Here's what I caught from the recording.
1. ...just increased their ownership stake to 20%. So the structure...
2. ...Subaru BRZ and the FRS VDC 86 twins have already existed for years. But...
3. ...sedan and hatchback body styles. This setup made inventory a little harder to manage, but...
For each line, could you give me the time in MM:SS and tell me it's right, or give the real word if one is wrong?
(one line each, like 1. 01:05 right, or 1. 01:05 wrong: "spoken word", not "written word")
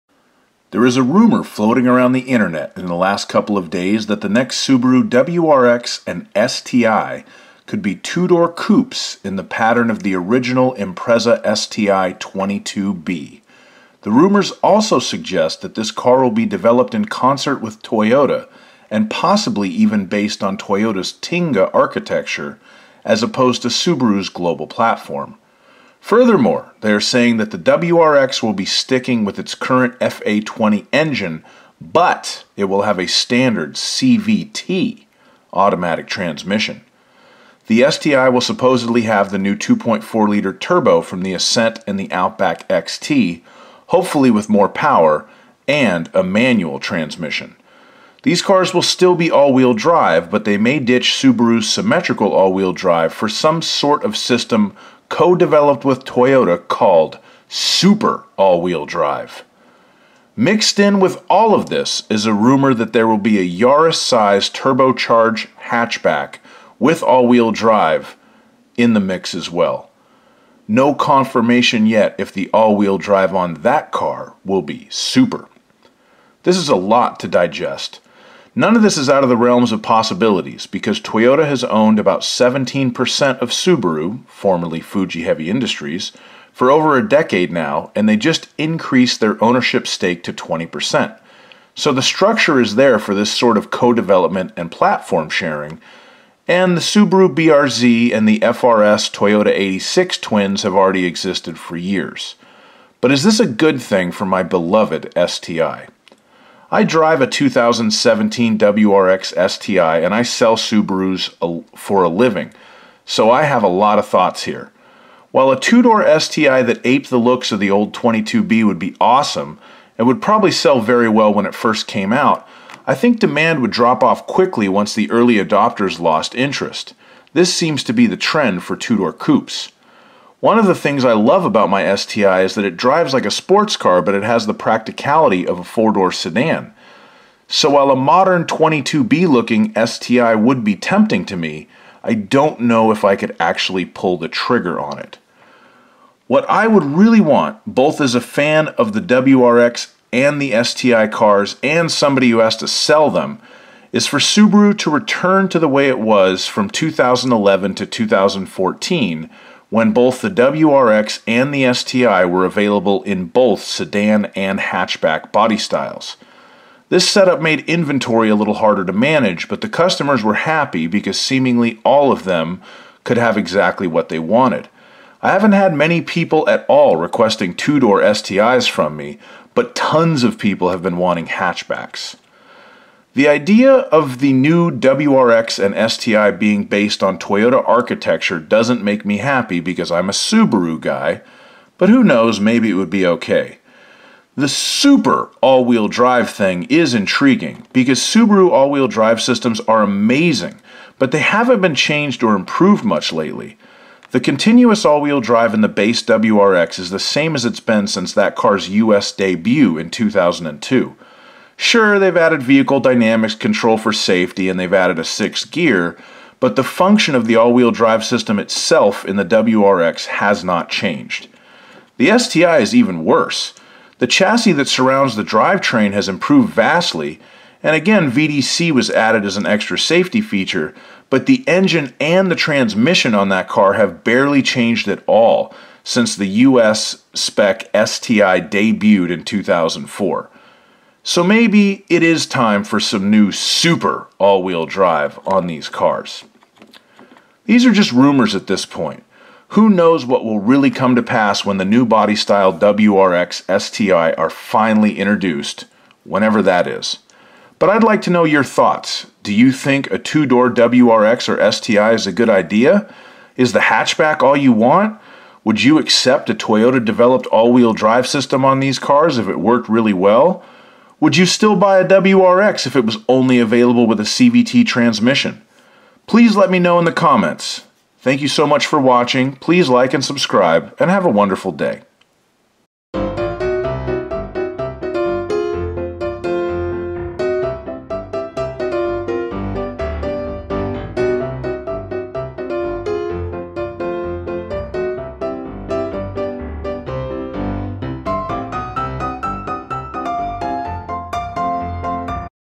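1. 01:28 right
2. 01:36 wrong: "Toyota", not "VDC"
3. 02:43 right.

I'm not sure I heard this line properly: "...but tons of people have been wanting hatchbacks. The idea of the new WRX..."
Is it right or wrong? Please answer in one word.
right.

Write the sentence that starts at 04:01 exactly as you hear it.
So maybe it is time for some new super all-wheel drive on these cars.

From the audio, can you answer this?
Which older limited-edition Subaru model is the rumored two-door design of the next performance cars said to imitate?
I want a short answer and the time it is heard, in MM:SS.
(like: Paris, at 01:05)
Impreza STI 22B, at 00:10.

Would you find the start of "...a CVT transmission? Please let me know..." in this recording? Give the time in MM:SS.
04:33.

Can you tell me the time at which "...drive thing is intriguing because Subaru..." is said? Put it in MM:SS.
03:15.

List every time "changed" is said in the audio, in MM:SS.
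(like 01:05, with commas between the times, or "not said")
03:21, 03:40, 03:54.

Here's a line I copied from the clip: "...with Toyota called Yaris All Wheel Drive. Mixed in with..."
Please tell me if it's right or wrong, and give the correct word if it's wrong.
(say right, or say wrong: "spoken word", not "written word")
wrong: "Super", not "Yaris".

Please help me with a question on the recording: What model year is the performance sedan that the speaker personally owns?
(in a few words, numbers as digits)
2017.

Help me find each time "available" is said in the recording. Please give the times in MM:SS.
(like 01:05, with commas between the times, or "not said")
02:42, 04:33.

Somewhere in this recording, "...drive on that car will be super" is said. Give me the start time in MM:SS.
01:12.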